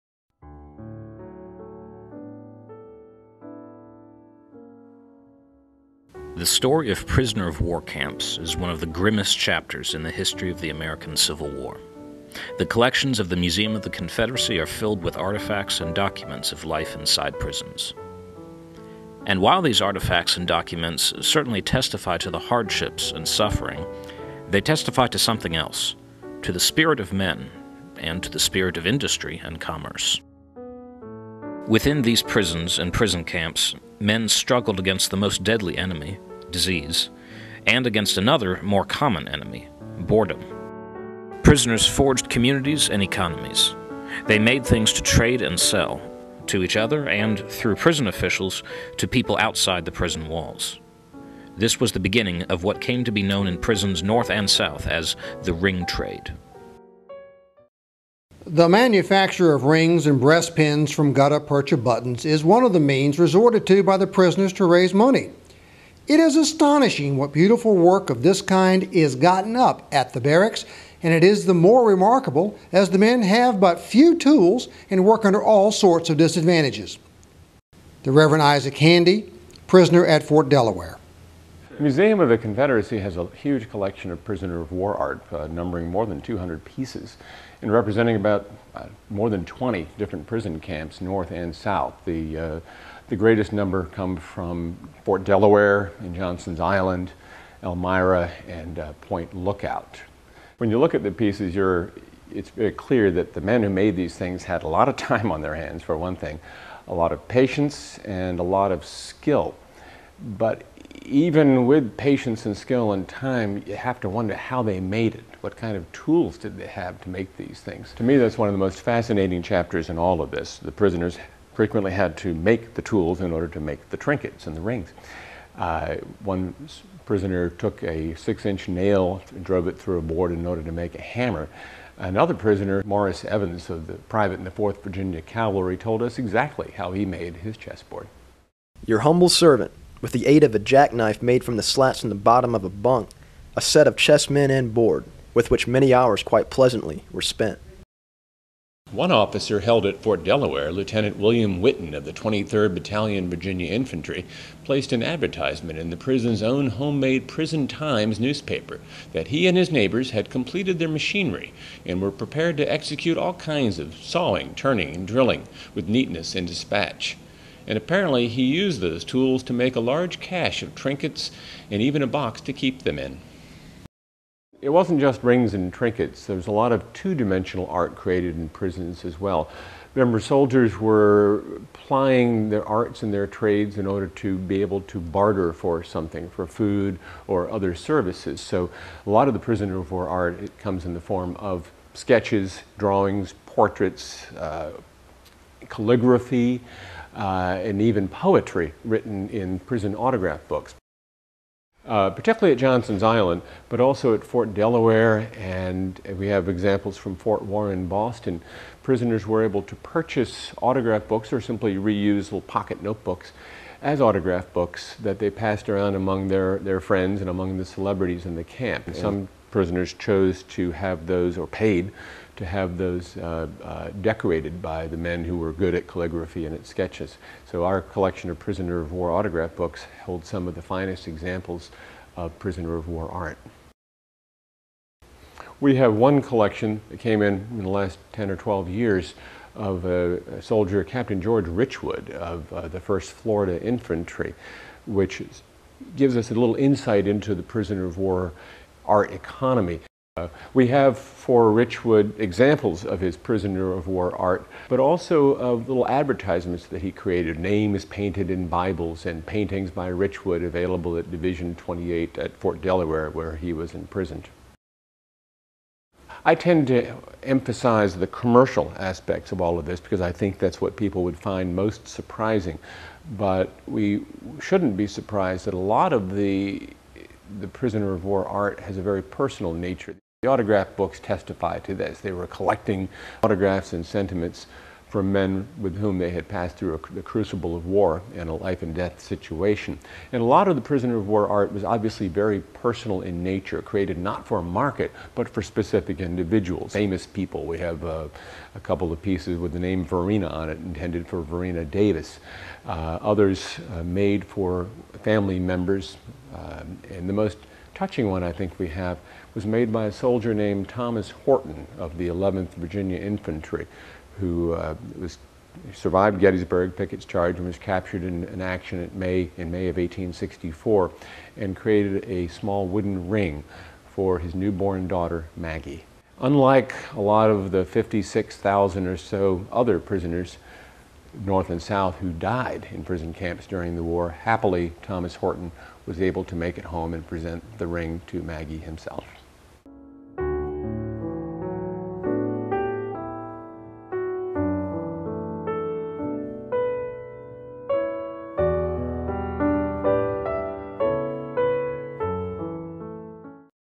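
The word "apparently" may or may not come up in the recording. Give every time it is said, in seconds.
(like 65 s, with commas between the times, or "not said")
167 s.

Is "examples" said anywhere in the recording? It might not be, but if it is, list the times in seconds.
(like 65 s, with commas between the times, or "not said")
206 s, 231 s, 252 s.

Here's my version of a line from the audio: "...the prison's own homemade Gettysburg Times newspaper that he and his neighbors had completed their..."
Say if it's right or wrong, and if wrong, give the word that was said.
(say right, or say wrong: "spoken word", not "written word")
wrong: "Prison", not "Gettysburg".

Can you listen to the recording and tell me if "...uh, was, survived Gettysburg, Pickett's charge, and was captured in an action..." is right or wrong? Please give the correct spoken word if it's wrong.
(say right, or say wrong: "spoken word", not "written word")
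right.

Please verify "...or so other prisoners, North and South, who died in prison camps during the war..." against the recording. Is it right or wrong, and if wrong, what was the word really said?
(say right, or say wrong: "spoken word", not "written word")
right.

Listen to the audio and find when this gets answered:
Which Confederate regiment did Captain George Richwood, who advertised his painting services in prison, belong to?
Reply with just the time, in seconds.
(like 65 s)
242 s.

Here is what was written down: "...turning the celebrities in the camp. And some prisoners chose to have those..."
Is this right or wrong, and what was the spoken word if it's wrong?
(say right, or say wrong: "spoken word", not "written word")
wrong: "among", not "turning".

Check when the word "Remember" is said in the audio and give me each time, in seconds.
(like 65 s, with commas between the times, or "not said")
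179 s.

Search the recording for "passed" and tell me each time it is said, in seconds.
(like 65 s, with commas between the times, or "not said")
215 s, 286 s.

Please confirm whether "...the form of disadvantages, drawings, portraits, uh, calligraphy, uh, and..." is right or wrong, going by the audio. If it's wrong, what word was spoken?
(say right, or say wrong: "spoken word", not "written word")
wrong: "sketches", not "disadvantages".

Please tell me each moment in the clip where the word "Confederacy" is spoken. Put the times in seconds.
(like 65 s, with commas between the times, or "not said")
13 s, 82 s.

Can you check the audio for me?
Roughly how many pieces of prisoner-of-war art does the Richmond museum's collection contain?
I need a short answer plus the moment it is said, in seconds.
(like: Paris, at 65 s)
more than 200, at 85 s.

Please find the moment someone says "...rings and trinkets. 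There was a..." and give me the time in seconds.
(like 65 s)
175 s.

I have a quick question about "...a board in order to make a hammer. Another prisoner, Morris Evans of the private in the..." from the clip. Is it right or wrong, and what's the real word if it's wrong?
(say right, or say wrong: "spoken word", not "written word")
right.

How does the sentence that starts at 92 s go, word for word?
The uh, the greatest number come from Fort Delaware and Johnson's Island, Elmira, and uh, Point Lookout.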